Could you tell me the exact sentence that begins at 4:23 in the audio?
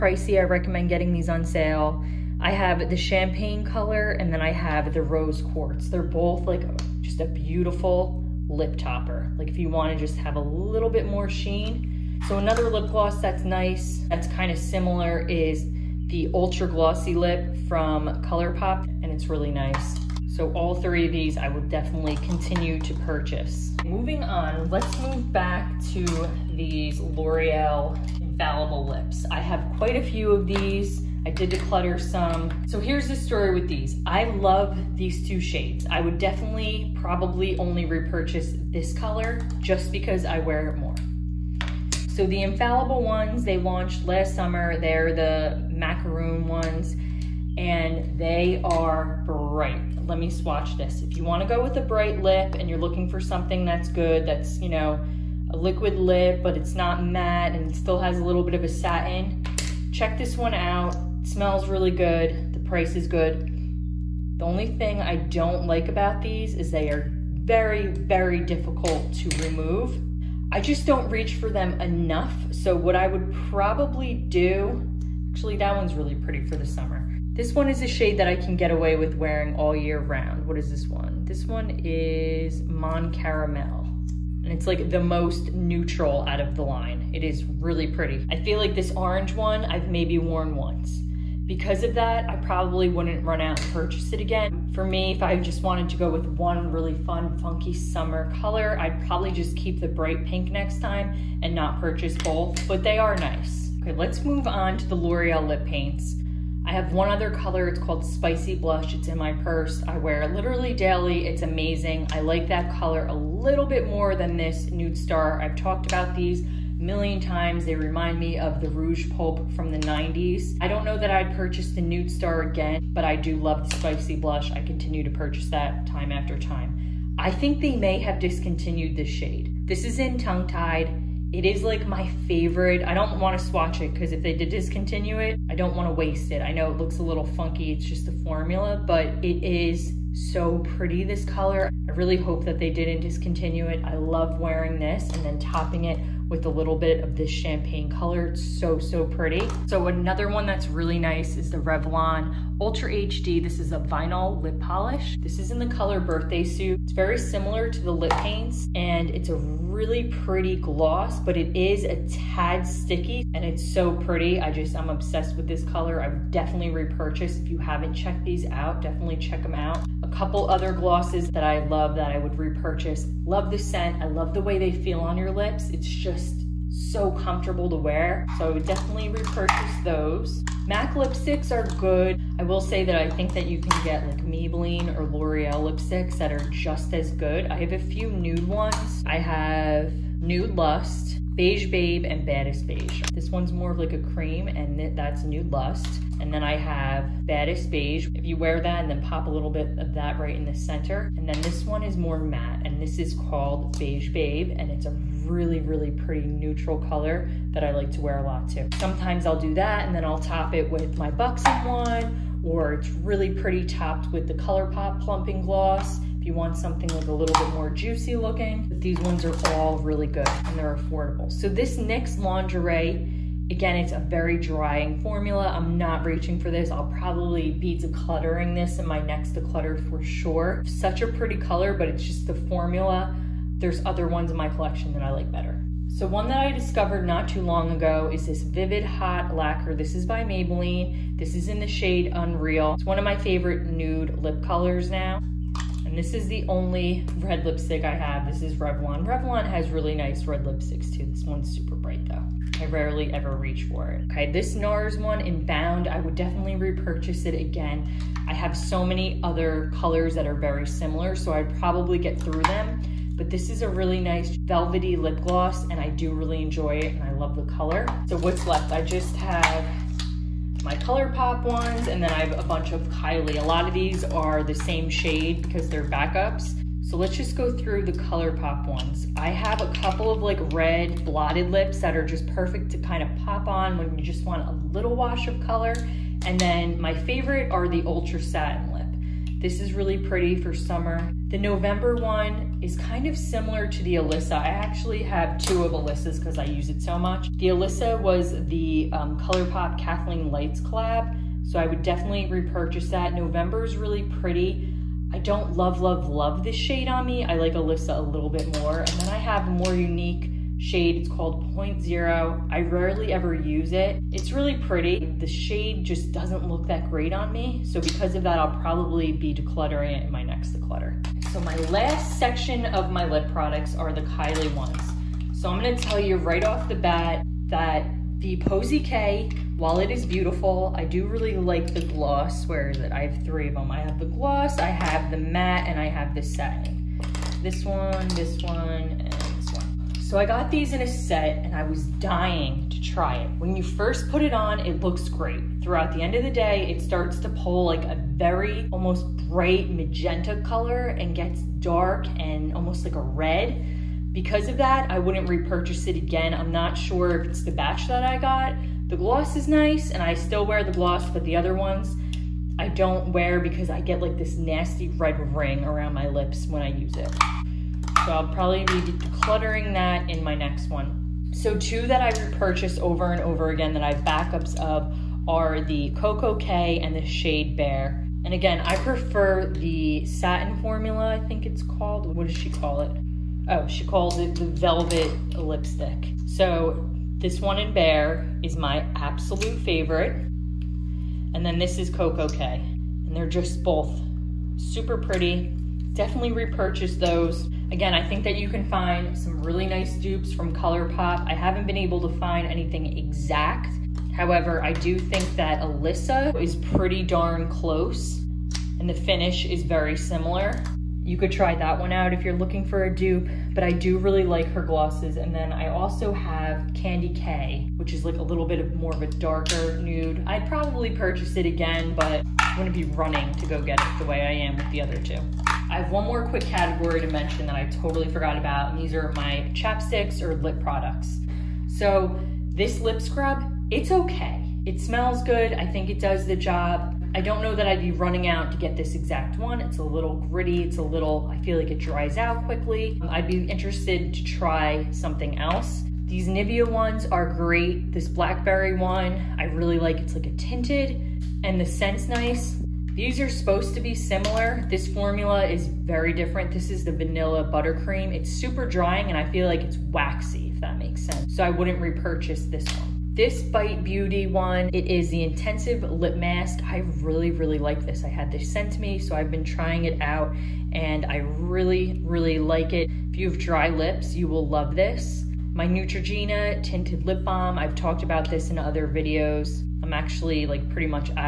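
But this is a really nice velvety lip gloss, and I do really enjoy it, and I love the color.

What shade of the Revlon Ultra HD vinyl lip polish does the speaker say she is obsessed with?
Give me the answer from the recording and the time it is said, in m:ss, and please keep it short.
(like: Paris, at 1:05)
Birthday Suit, at 2:36.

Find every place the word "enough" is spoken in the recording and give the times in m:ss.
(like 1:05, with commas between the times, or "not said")
1:11.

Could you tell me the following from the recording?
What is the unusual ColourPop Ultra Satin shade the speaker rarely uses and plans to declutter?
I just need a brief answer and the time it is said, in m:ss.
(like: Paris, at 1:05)
Point Zero, at 5:11.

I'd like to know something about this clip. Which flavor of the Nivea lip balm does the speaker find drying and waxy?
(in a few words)
vanilla buttercream.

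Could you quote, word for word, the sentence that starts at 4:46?
And then my favorite are the Ultra Satin Lip.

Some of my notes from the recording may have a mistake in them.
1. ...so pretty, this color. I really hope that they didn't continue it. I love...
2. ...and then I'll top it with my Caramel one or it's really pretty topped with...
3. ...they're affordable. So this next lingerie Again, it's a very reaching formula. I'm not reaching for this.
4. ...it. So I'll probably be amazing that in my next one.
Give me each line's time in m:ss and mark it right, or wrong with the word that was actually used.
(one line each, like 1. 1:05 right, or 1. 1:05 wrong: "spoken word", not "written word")
1. 2:20 wrong: "discontinue", not "continue"
2. 3:29 wrong: "Buxom", not "Caramel"
3. 3:40 wrong: "drying", not "reaching"
4. 6:06 wrong: "decluttering", not "amazing".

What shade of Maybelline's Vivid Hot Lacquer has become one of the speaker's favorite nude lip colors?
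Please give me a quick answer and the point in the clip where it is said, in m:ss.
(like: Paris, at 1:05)
Unreal, at 4:02.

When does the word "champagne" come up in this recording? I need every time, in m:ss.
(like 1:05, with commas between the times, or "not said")
0:02, 2:27.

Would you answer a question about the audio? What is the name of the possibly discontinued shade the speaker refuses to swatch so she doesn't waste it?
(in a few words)
Tongue Tied.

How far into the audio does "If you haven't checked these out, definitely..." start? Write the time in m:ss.
2:47.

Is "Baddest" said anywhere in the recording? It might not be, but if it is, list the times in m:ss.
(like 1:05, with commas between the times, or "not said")
3:12, 3:17.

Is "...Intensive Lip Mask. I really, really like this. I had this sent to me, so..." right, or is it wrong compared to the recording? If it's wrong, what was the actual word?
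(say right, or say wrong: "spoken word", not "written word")
right.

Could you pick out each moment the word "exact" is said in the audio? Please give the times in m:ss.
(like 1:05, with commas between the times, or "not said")
6:42, 7:18.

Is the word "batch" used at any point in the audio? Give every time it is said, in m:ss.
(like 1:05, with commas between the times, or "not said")
5:57.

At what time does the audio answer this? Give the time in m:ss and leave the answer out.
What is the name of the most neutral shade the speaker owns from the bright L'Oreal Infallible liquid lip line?
1:22.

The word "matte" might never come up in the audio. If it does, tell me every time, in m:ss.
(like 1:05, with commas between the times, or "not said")
0:57, 3:22, 5:35.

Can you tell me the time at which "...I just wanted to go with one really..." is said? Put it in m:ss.
1:35.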